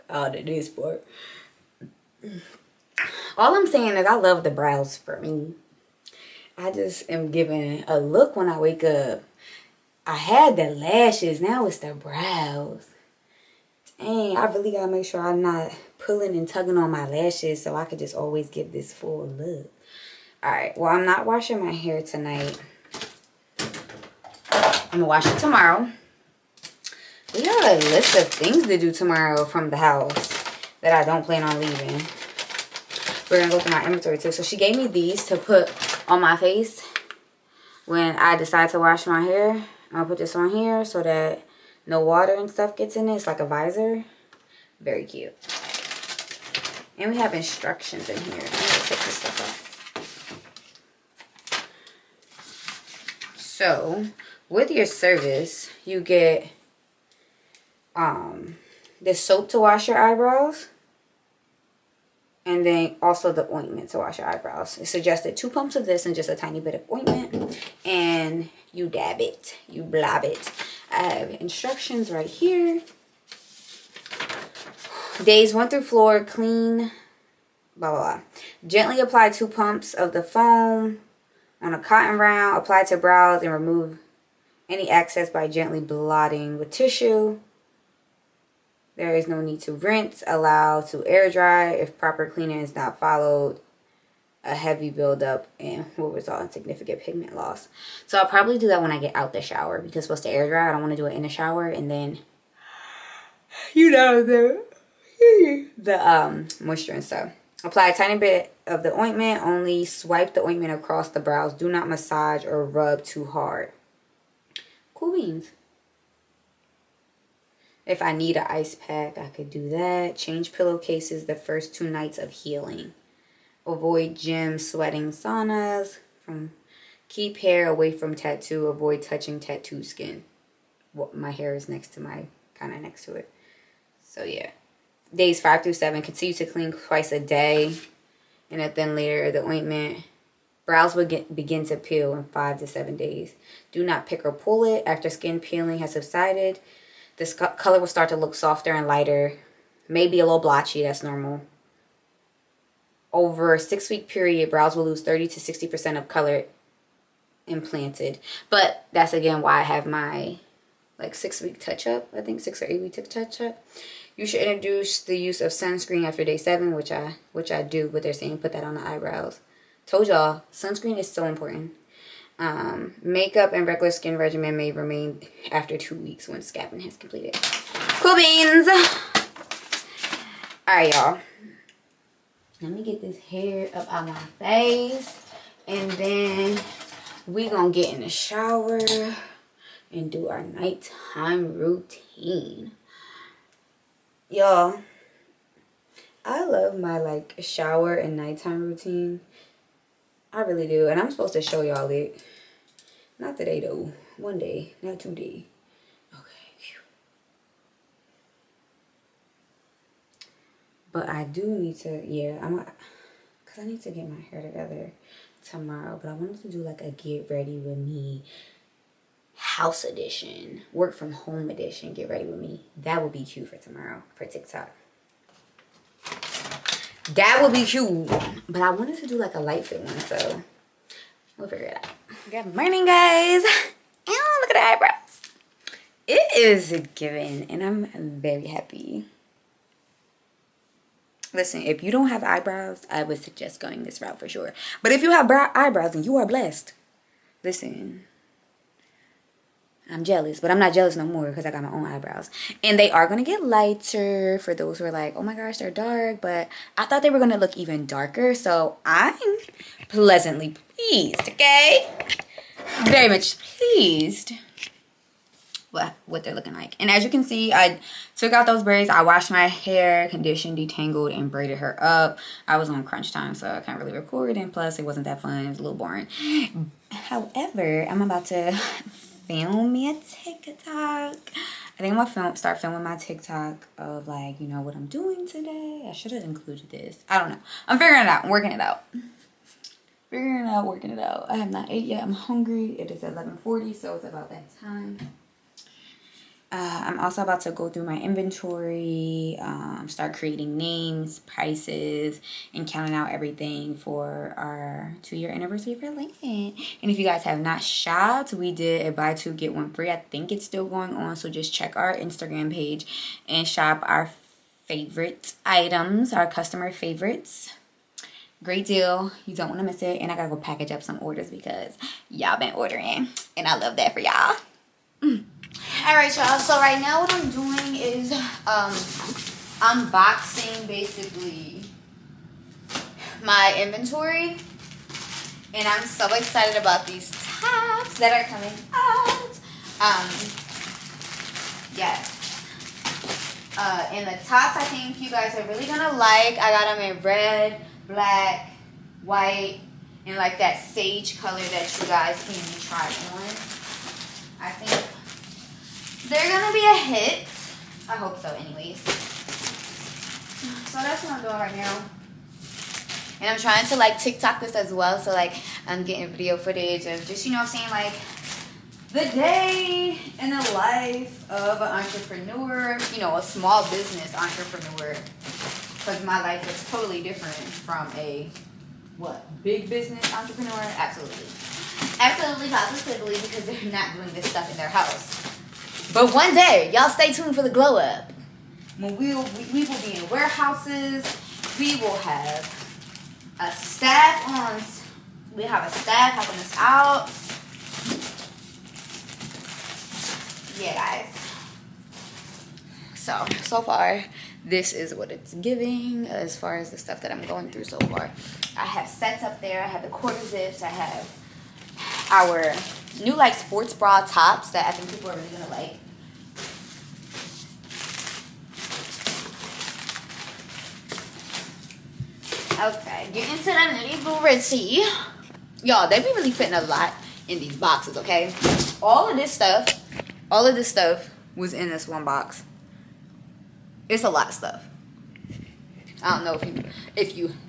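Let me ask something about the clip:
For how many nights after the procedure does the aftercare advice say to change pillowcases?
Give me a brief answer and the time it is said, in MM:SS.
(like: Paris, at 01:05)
2, at 02:01.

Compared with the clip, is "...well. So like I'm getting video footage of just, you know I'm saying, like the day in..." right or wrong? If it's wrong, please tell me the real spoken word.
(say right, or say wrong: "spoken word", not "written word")
right.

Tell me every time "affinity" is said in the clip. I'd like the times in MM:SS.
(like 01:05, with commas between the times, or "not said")
not said.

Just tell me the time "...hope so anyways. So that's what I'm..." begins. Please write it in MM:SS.
05:57.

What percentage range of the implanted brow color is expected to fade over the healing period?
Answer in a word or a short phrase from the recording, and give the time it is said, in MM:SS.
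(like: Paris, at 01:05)
30 to 60%, at 02:35.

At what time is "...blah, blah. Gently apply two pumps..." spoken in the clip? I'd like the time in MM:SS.
01:17.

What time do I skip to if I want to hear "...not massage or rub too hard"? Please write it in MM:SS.
01:51.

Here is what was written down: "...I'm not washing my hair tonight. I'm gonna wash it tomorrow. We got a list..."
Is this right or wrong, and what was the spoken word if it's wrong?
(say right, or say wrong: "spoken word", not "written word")
right.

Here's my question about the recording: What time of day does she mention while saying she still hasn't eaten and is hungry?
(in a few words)
11:40.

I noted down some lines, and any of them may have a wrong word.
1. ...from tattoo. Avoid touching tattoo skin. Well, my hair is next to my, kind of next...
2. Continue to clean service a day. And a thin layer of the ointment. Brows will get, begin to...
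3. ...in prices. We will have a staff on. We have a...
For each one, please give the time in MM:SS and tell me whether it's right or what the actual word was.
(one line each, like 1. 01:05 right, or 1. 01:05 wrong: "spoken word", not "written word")
1. 02:07 right
2. 02:16 wrong: "twice", not "service"
3. 06:29 wrong: "warehouses", not "prices".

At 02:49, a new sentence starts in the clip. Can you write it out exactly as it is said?
Told y'all, sunscreen is so important.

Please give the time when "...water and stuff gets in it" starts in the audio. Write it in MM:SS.
00:42.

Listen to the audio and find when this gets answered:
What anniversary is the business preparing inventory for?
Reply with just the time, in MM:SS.
05:05.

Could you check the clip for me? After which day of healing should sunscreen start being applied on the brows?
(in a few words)
Day 7.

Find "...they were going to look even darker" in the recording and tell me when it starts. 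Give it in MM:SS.
04:17.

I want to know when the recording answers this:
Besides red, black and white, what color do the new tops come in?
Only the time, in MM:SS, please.
05:50.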